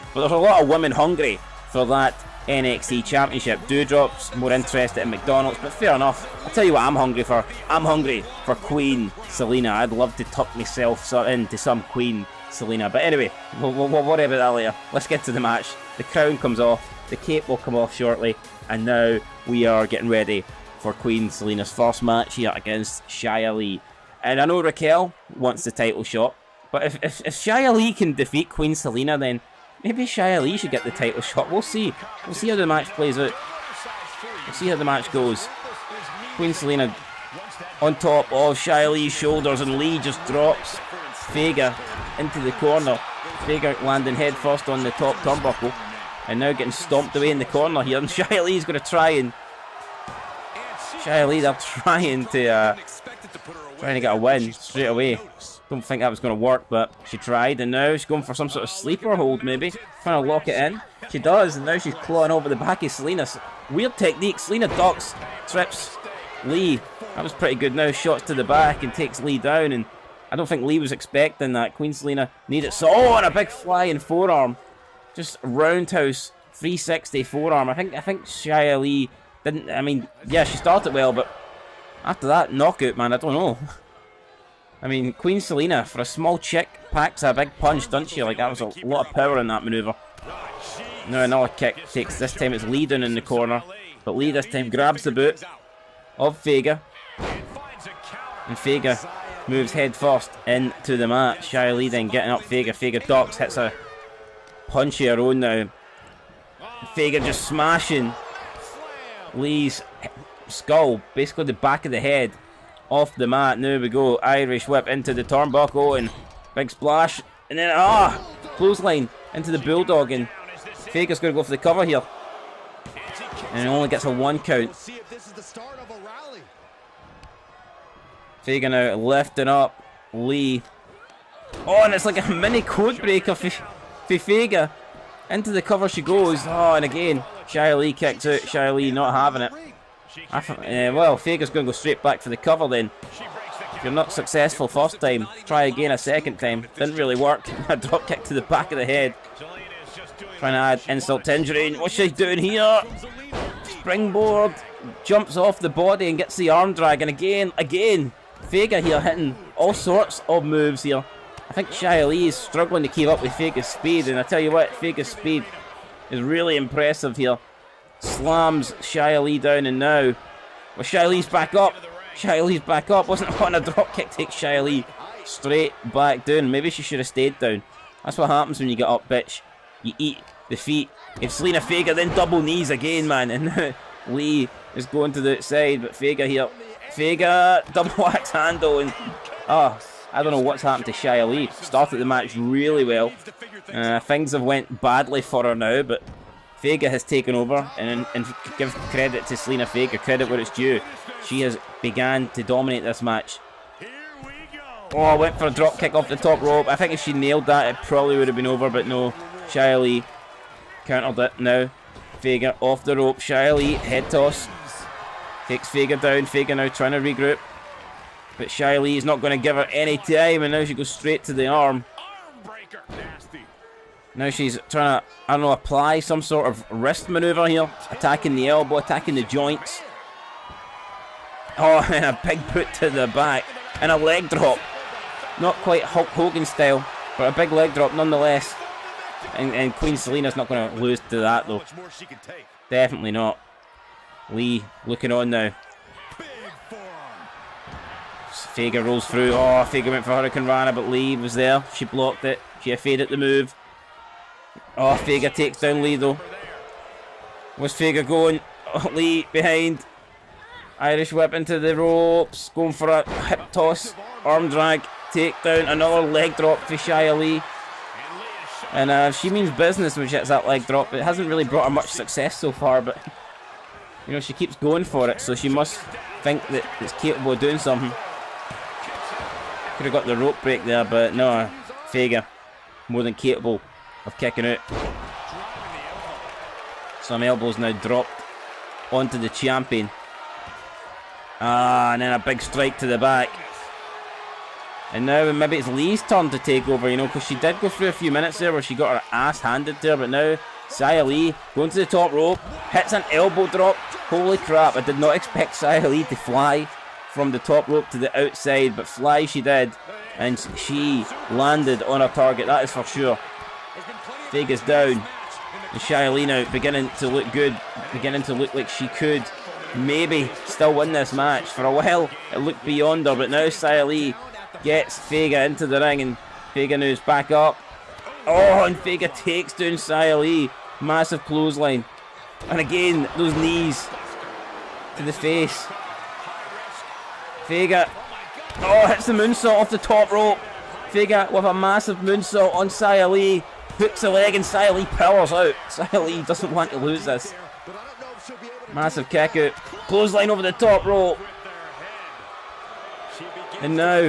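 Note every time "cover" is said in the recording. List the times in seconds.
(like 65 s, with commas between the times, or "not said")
121 s, 135 s, 142 s.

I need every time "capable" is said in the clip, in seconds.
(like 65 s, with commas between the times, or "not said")
276 s, 283 s.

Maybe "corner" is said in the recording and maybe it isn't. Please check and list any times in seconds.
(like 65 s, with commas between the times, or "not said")
42 s, 47 s, 93 s.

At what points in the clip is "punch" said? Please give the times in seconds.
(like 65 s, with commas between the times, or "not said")
87 s, 104 s.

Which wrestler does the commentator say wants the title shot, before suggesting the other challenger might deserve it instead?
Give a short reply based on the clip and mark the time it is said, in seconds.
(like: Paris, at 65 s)
Raquel, at 24 s.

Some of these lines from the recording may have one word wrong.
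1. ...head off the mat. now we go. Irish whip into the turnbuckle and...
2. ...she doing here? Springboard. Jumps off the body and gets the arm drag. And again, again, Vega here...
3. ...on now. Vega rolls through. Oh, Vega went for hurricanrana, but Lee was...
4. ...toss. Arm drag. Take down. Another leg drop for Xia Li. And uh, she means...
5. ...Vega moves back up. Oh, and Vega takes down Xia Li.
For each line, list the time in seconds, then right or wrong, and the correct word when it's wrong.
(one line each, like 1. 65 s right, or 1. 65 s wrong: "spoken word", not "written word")
1. 111 s right
2. 151 s right
3. 245 s right
4. 263 s right
5. 326 s right.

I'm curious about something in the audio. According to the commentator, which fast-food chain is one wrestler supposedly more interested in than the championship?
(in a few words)
McDonald's.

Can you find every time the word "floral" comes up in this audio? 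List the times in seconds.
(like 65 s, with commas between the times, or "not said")
not said.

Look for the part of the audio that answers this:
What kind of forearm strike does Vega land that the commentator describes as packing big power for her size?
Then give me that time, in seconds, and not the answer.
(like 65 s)
75 s.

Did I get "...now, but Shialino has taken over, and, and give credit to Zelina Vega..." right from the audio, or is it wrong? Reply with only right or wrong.
wrong.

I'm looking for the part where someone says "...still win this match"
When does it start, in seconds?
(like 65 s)
320 s.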